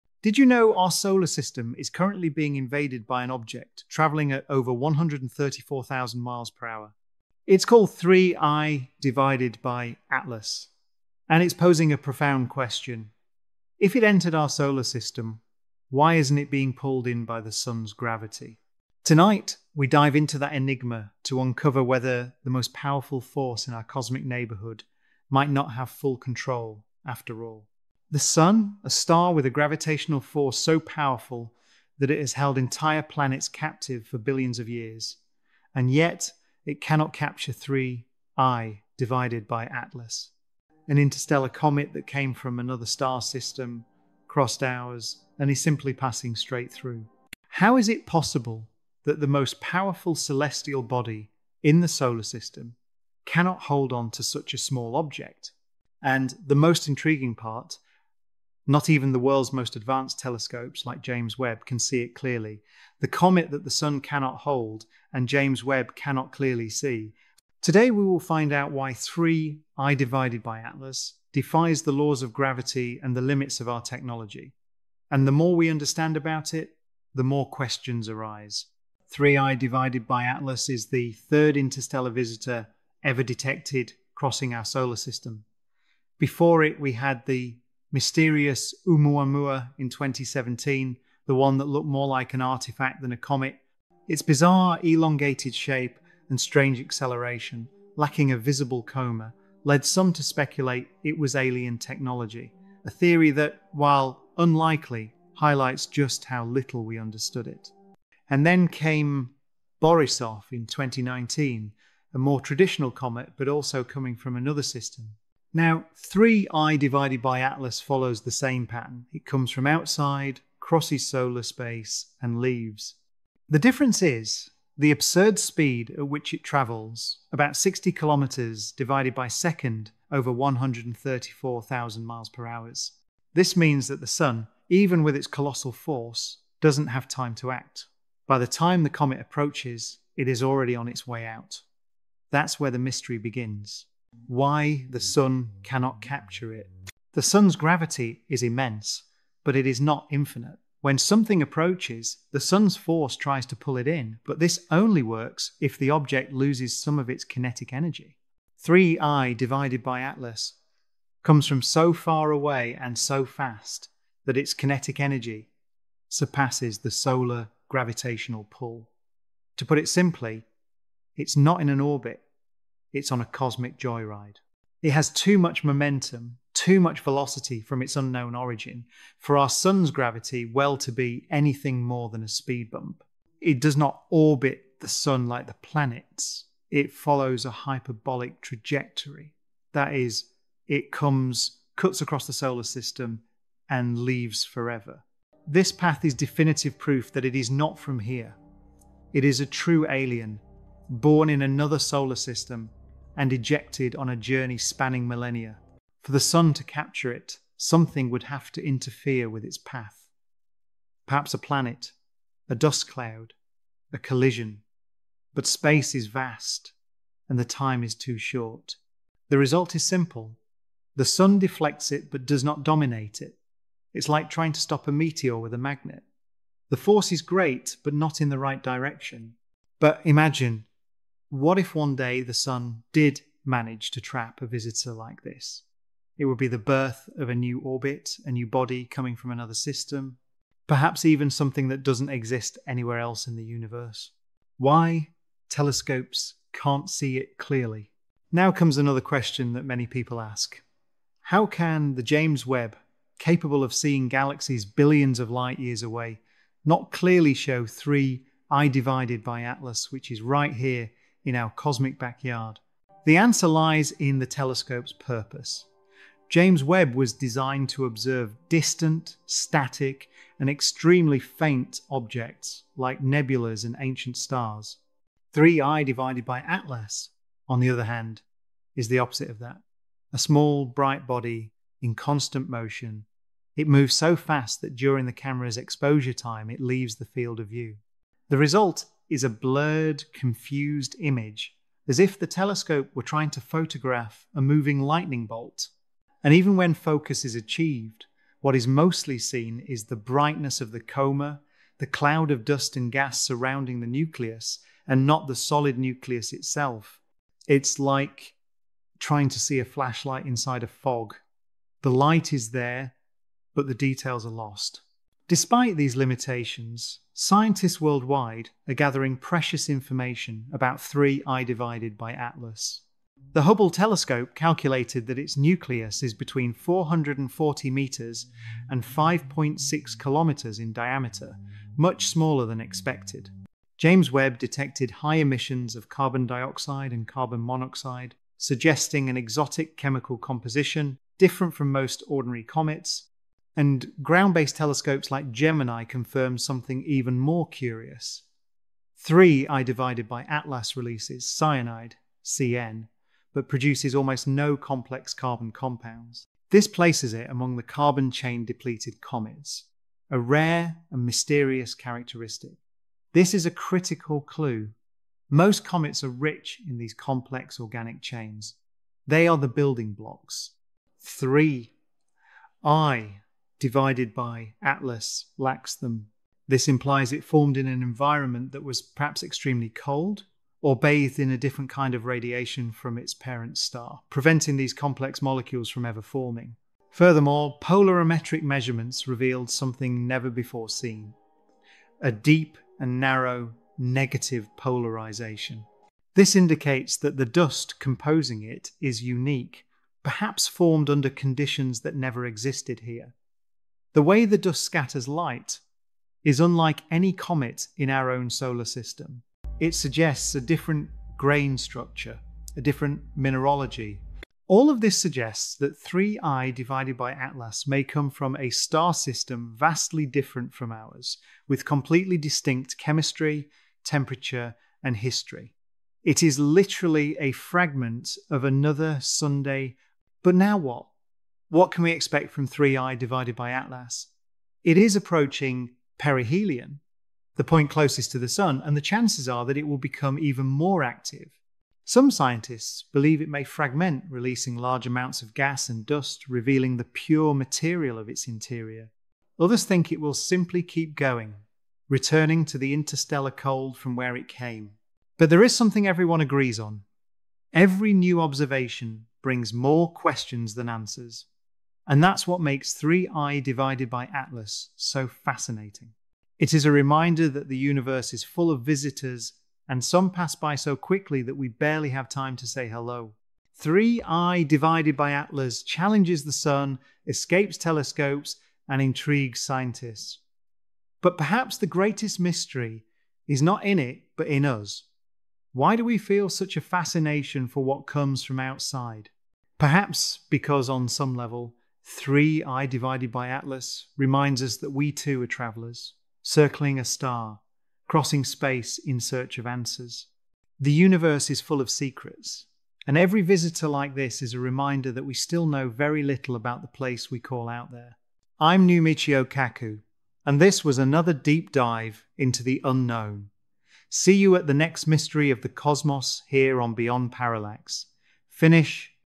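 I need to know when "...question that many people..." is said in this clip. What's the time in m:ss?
4:08.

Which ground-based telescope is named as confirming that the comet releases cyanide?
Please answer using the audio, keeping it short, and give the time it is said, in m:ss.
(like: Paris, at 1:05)
Gemini, at 5:45.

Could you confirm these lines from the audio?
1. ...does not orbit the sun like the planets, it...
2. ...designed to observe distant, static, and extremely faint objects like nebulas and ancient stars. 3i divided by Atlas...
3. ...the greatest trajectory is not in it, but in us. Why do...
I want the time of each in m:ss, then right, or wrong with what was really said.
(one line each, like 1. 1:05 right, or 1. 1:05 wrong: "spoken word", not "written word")
1. 3:03 right
2. 4:27 right
3. 8:01 wrong: "mystery", not "trajectory".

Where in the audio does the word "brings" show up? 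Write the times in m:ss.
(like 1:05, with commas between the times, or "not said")
7:39.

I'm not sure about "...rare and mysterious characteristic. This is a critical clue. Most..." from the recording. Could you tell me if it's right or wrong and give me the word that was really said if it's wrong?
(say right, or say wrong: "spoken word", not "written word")
right.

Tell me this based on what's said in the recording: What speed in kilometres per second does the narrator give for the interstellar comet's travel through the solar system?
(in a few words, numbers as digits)
60 km/s.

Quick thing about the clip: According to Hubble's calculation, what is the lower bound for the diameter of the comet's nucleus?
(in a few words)
440 metres.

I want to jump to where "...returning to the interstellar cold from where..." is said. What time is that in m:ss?
7:31.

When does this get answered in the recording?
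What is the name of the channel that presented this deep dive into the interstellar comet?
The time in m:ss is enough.
8:36.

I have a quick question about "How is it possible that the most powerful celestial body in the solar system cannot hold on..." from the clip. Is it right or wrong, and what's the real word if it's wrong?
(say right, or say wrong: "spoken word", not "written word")
right.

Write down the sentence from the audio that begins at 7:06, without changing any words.
It is literally a fragment of another Sunday.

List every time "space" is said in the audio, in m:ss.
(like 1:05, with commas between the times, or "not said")
2:01, 3:35, 8:18.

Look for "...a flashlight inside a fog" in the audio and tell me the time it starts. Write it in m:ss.
5:09.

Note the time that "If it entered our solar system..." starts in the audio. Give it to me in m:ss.
0:13.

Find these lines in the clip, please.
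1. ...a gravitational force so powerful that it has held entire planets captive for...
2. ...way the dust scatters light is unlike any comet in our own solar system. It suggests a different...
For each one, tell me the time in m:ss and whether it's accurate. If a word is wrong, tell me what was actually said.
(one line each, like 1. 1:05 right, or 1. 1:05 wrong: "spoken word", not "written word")
1. 0:29 right
2. 6:44 right.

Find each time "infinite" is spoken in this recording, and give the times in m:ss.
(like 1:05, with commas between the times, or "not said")
2:30.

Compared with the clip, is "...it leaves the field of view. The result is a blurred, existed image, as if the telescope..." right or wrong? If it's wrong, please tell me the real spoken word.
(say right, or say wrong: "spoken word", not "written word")
wrong: "confused", not "existed".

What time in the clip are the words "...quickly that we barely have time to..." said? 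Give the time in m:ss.
7:50.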